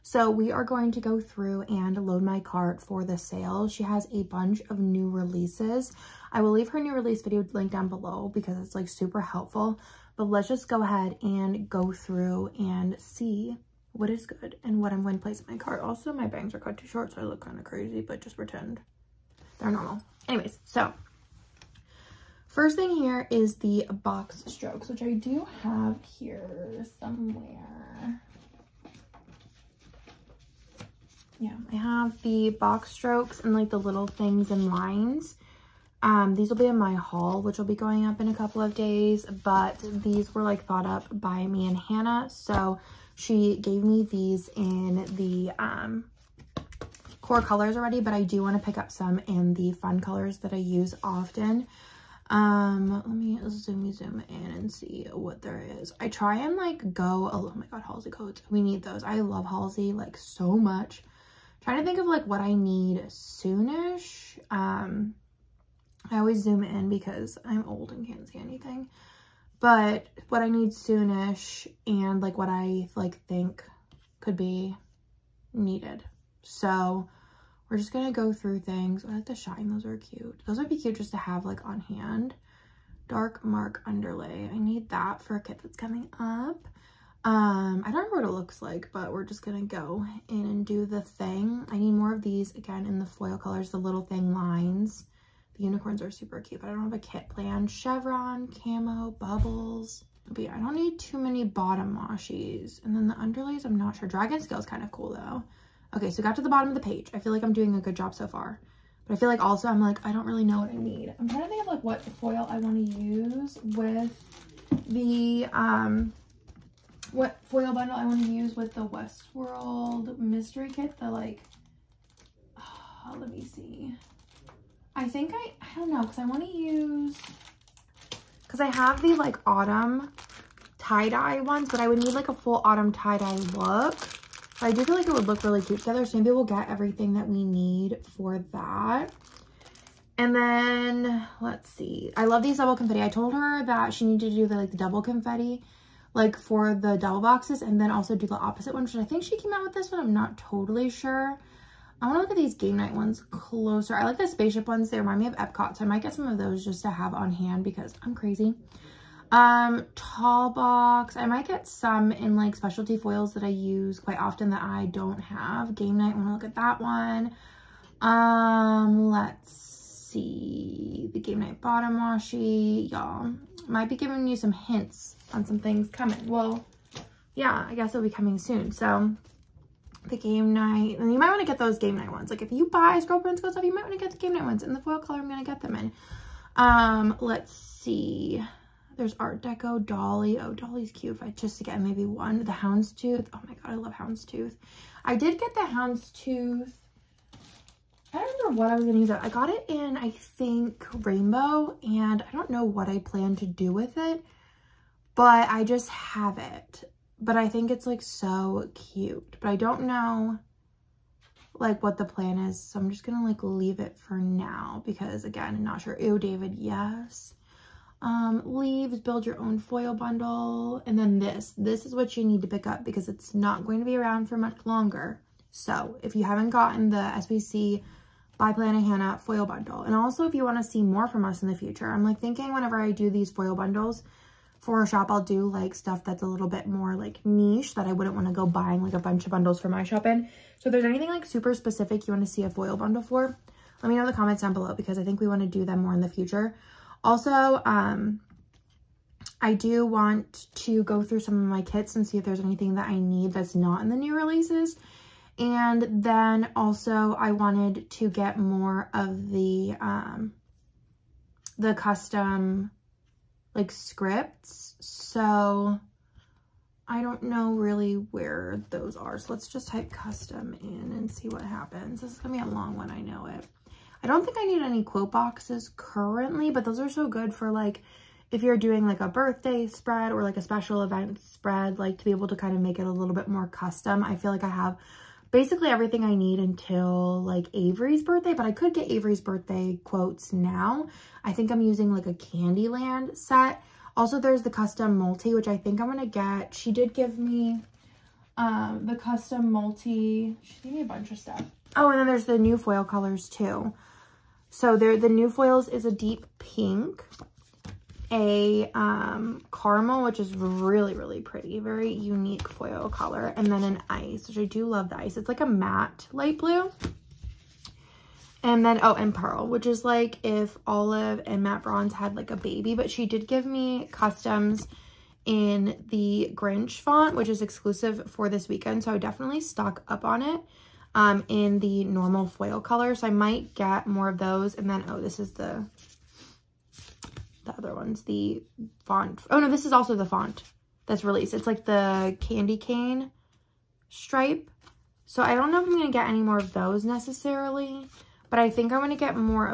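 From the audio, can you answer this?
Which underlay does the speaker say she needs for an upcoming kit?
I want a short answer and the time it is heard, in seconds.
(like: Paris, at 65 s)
Dark mark underlay, at 83 s.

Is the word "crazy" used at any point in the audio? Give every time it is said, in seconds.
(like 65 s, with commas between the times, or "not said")
17 s, 158 s.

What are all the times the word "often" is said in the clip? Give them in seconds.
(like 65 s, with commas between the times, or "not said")
51 s, 164 s.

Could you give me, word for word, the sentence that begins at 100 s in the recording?
But yeah, I don't need too many bottom washies.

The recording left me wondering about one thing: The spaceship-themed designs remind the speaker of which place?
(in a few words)
Epcot.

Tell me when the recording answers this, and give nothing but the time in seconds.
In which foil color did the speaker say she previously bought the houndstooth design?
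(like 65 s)
201 s.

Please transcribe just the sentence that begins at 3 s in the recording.
She has a bunch of new releases.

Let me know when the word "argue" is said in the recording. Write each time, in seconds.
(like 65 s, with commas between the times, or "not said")
not said.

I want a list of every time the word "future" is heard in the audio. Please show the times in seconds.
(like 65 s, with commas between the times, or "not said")
231 s, 246 s.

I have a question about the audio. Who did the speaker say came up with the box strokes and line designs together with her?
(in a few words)
Hannah.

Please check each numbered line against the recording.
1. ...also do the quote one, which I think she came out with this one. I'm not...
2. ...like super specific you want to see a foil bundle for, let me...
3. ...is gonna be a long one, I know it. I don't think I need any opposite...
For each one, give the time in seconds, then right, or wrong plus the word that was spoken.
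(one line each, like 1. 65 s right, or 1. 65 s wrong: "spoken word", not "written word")
1. 147 s wrong: "opposite", not "quote"
2. 241 s right
3. 272 s wrong: "quote", not "opposite".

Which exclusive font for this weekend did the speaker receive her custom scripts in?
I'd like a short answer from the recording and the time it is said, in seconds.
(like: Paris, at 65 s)
Grinch, at 326 s.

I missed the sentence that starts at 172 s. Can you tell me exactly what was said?
Y'all, might be giving you some hints on some things coming.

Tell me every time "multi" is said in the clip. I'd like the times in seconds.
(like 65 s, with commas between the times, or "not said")
294 s, 299 s.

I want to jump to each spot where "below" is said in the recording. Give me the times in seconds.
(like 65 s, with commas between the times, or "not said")
7 s, 244 s.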